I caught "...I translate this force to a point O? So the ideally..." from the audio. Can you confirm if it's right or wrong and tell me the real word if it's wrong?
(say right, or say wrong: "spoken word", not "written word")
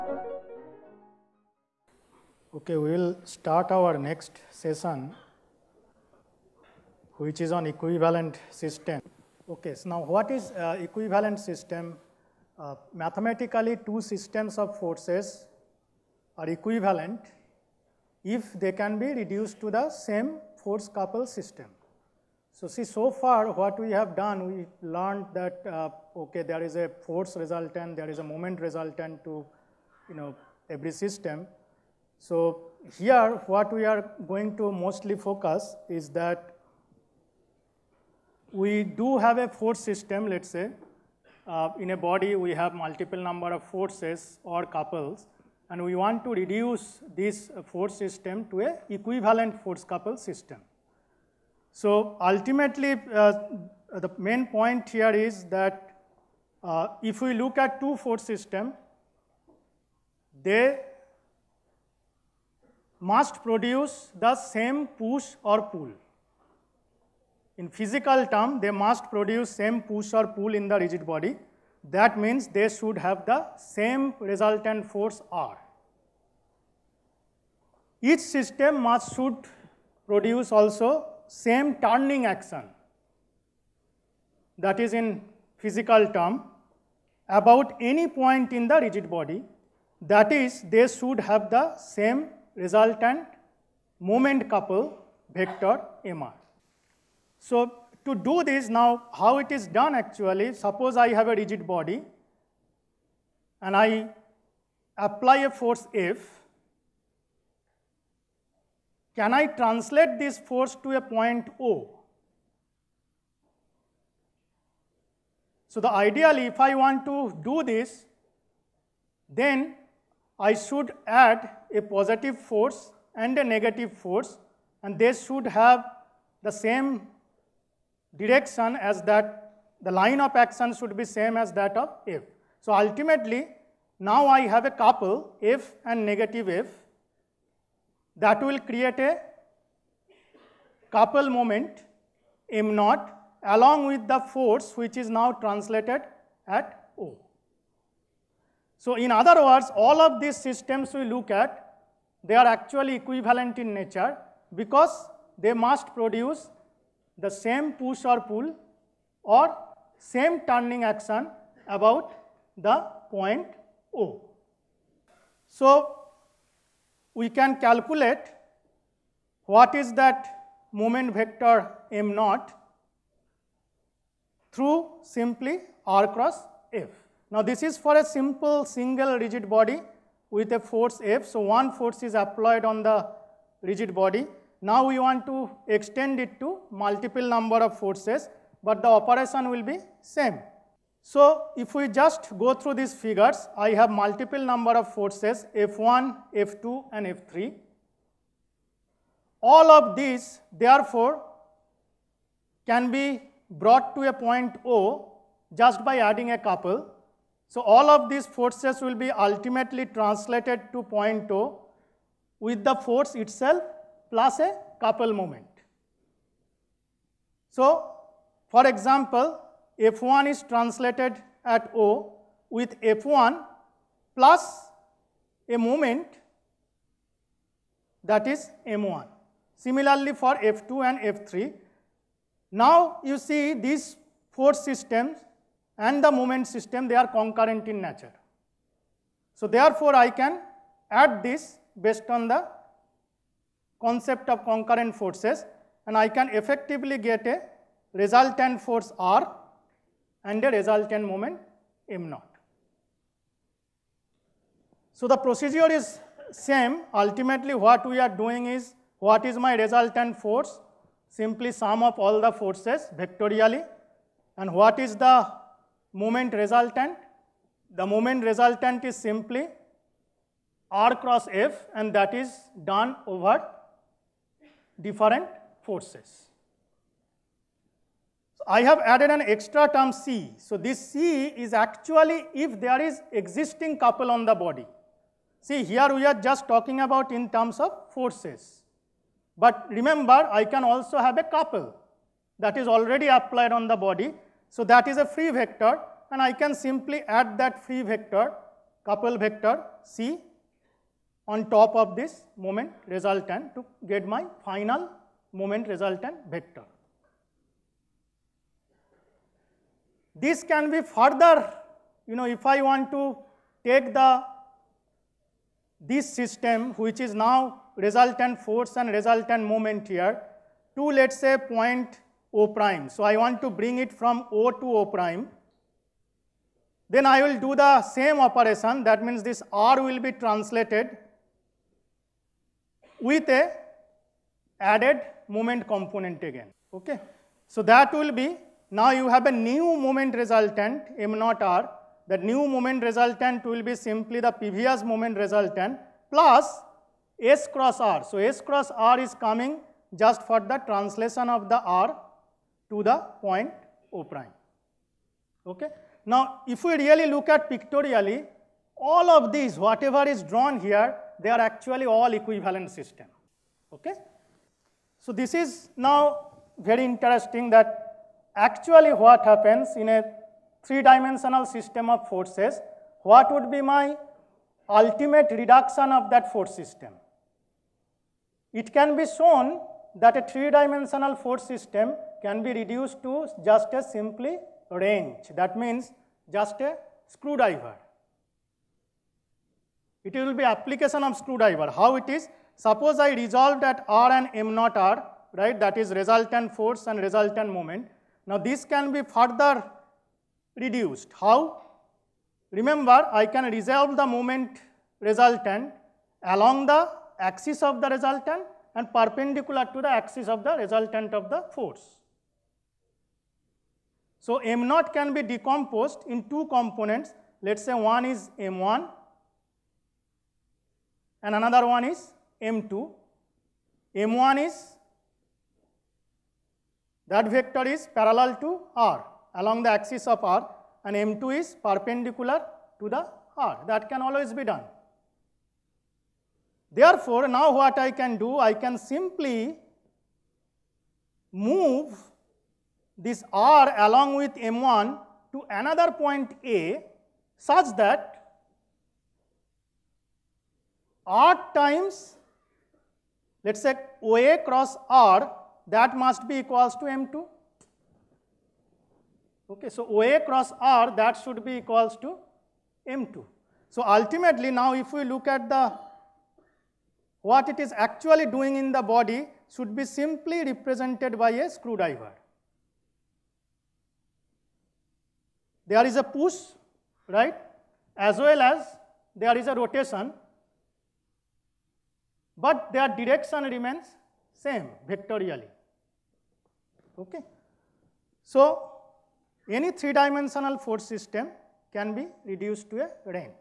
right.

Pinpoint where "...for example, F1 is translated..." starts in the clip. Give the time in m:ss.
3:38.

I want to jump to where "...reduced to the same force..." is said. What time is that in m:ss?
0:19.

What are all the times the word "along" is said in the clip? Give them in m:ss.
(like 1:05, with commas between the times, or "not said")
2:23, 6:46, 7:09, 7:23.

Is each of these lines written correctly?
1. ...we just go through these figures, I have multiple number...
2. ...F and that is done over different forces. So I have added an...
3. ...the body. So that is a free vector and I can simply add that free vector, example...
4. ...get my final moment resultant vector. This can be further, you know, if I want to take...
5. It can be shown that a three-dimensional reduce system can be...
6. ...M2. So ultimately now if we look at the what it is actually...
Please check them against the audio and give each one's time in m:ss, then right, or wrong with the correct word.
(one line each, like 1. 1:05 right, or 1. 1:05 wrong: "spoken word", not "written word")
1. 3:11 right
2. 4:31 right
3. 4:53 wrong: "couple", not "example"
4. 5:03 right
5. 6:18 wrong: "force", not "reduce"
6. 7:42 right.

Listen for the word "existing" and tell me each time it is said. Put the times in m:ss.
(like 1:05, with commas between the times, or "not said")
4:43.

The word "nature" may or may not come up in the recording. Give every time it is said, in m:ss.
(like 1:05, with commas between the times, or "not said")
2:33, 3:57.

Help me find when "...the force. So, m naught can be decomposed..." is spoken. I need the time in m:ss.
6:51.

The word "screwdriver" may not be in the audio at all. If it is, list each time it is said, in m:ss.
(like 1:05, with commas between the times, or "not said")
6:27, 6:31, 7:51.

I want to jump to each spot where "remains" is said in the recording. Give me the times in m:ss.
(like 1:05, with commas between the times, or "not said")
8:03.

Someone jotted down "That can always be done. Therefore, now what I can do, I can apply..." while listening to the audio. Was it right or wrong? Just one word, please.
wrong.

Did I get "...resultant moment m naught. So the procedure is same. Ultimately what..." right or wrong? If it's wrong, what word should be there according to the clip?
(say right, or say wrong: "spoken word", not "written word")
right.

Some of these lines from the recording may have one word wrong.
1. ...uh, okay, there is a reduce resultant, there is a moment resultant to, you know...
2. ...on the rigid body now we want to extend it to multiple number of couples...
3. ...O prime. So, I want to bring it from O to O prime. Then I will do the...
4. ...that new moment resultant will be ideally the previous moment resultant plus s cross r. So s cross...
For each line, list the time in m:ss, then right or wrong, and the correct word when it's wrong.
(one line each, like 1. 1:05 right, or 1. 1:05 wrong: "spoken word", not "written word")
1. 0:25 wrong: "force", not "reduce"
2. 3:02 wrong: "forces", not "couples"
3. 5:22 right
4. 5:42 wrong: "simply", not "ideally".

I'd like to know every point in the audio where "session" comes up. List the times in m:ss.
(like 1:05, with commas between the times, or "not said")
0:04.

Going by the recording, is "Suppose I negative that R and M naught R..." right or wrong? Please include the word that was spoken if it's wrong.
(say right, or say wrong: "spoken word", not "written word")
wrong: "resolve", not "negative".